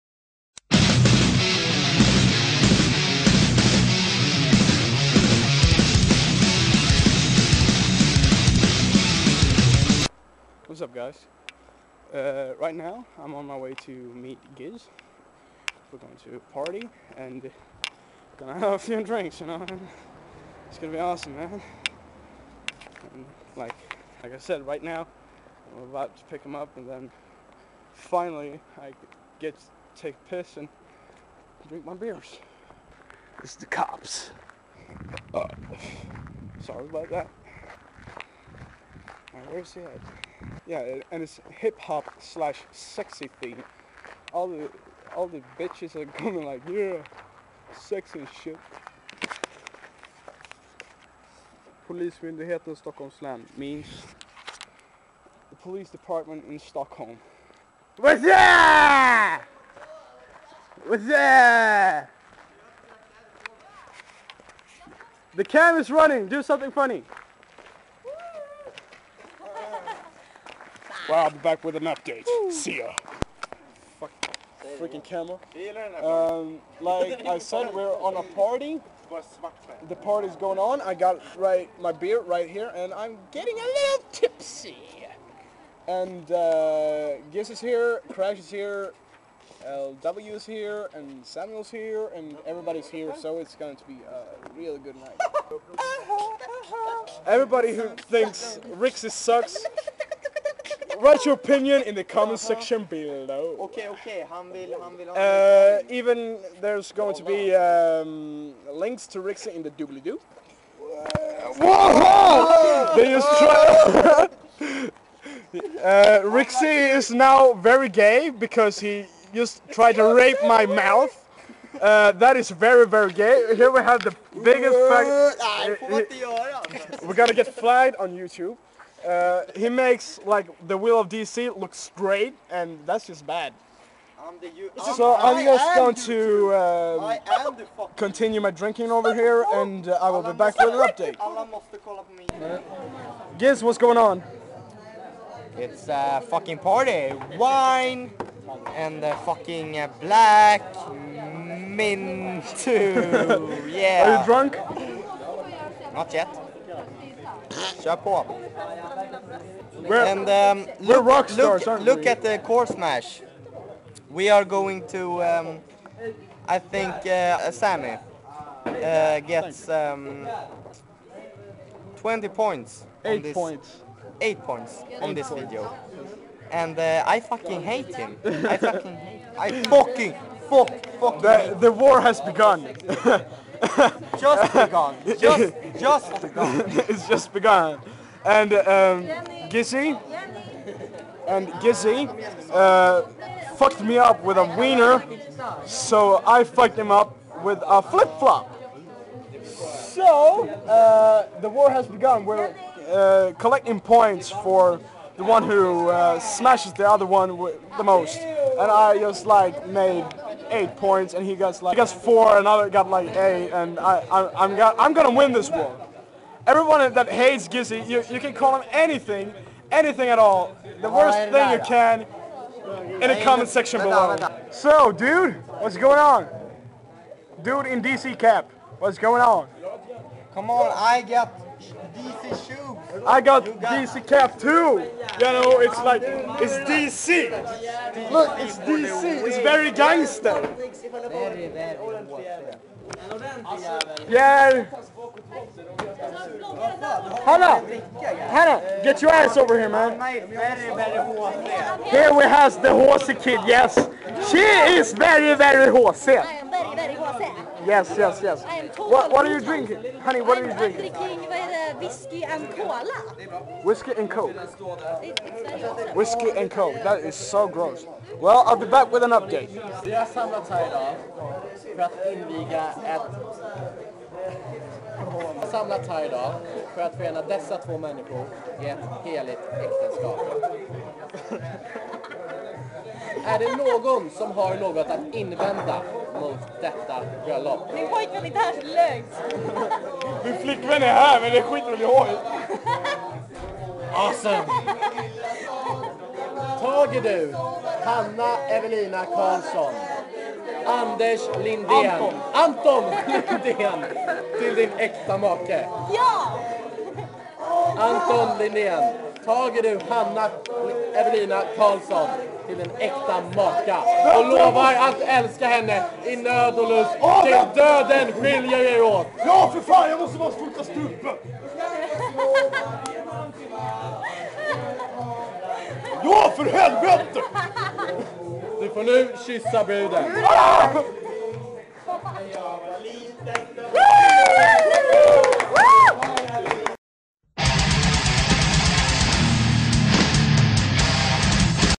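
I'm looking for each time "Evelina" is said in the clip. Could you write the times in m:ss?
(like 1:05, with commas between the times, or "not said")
4:58, 5:11.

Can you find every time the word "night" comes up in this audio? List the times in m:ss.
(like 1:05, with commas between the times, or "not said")
1:34.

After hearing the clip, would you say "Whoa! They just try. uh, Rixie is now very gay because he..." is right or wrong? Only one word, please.
right.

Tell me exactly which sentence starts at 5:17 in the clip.
Ja, till döden skiljer er åt!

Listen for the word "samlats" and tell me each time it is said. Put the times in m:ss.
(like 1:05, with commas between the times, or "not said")
4:30, 4:35.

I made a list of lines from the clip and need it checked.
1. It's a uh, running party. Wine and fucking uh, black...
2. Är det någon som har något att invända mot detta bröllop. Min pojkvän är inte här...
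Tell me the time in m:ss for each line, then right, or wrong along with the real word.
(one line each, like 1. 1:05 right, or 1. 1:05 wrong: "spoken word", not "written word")
1. 2:25 wrong: "fucking", not "running"
2. 4:43 right.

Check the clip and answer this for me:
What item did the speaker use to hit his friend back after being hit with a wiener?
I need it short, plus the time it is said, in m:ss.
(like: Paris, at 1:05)
flip-flop, at 3:17.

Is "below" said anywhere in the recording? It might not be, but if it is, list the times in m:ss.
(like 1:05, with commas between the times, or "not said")
1:42, 3:43.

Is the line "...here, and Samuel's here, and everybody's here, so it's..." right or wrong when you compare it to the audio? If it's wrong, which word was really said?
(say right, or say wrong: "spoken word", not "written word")
right.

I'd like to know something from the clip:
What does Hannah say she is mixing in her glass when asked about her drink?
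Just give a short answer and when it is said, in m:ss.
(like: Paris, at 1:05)
whiskey and cola, at 4:21.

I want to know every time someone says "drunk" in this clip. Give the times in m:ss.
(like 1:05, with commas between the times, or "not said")
2:34.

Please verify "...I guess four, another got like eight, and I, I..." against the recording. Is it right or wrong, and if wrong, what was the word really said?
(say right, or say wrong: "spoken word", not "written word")
right.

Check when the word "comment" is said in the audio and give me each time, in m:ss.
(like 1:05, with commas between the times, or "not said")
1:42, 3:43.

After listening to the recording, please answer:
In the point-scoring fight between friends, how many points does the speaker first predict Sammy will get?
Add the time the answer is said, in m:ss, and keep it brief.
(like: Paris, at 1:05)
20, at 2:51.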